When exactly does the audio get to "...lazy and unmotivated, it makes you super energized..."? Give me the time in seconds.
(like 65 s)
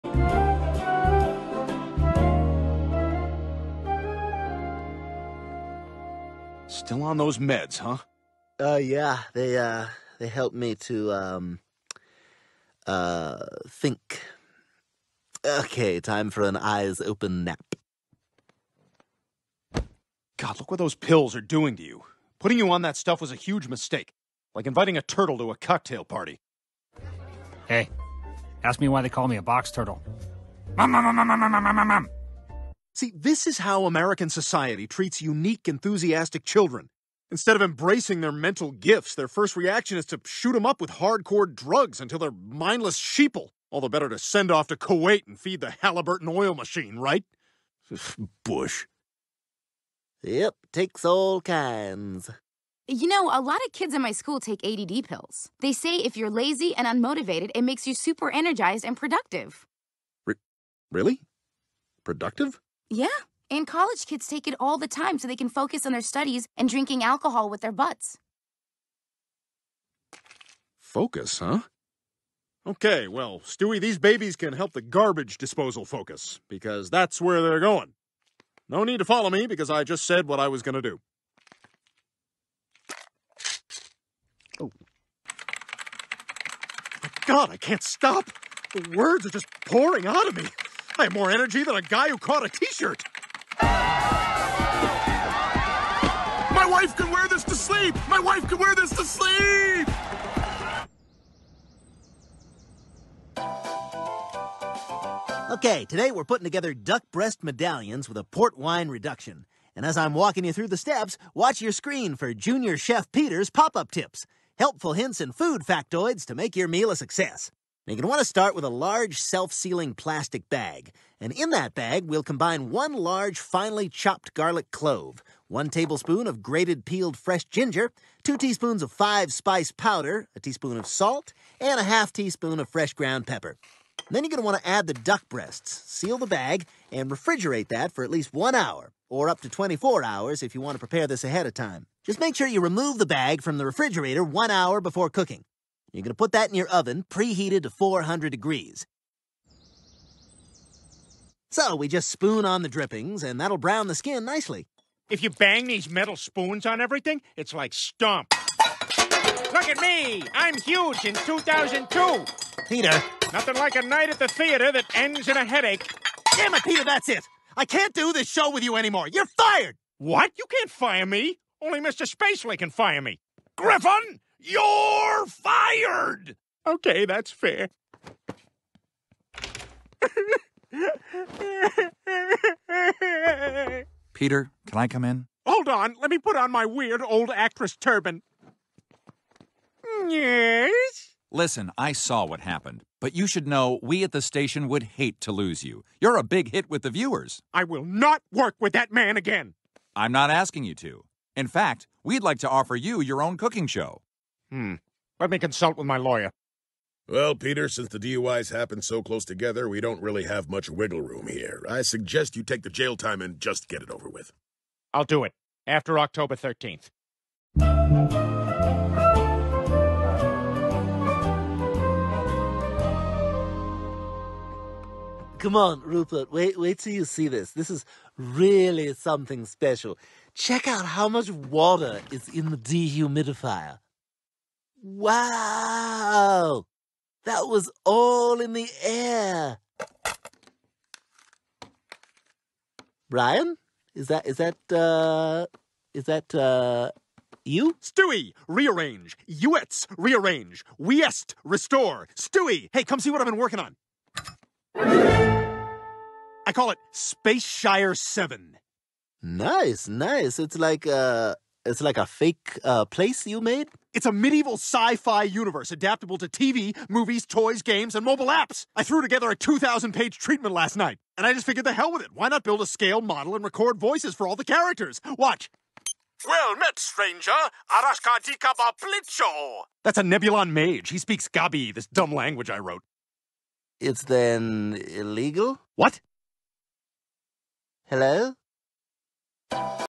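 56 s.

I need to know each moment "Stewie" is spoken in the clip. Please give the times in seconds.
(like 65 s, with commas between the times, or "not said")
73 s, 247 s, 252 s.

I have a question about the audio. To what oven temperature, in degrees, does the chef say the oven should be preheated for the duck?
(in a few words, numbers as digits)
400.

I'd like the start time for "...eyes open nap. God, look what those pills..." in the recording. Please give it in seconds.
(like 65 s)
16 s.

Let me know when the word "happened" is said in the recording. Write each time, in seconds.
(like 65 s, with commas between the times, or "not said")
192 s, 208 s.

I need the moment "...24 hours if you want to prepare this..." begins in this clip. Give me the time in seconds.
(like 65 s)
139 s.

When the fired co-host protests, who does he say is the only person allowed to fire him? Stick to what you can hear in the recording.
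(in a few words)
Mr. Spacely.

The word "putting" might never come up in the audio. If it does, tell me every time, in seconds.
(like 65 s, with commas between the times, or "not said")
22 s, 106 s.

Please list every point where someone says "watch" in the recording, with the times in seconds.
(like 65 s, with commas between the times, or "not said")
111 s, 275 s.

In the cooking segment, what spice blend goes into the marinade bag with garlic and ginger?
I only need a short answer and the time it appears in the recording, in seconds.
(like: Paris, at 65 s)
five-spice powder, at 128 s.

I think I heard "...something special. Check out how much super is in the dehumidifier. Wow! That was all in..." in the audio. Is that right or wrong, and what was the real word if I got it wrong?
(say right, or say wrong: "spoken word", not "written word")
wrong: "water", not "super".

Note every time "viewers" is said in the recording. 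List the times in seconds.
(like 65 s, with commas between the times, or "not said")
196 s.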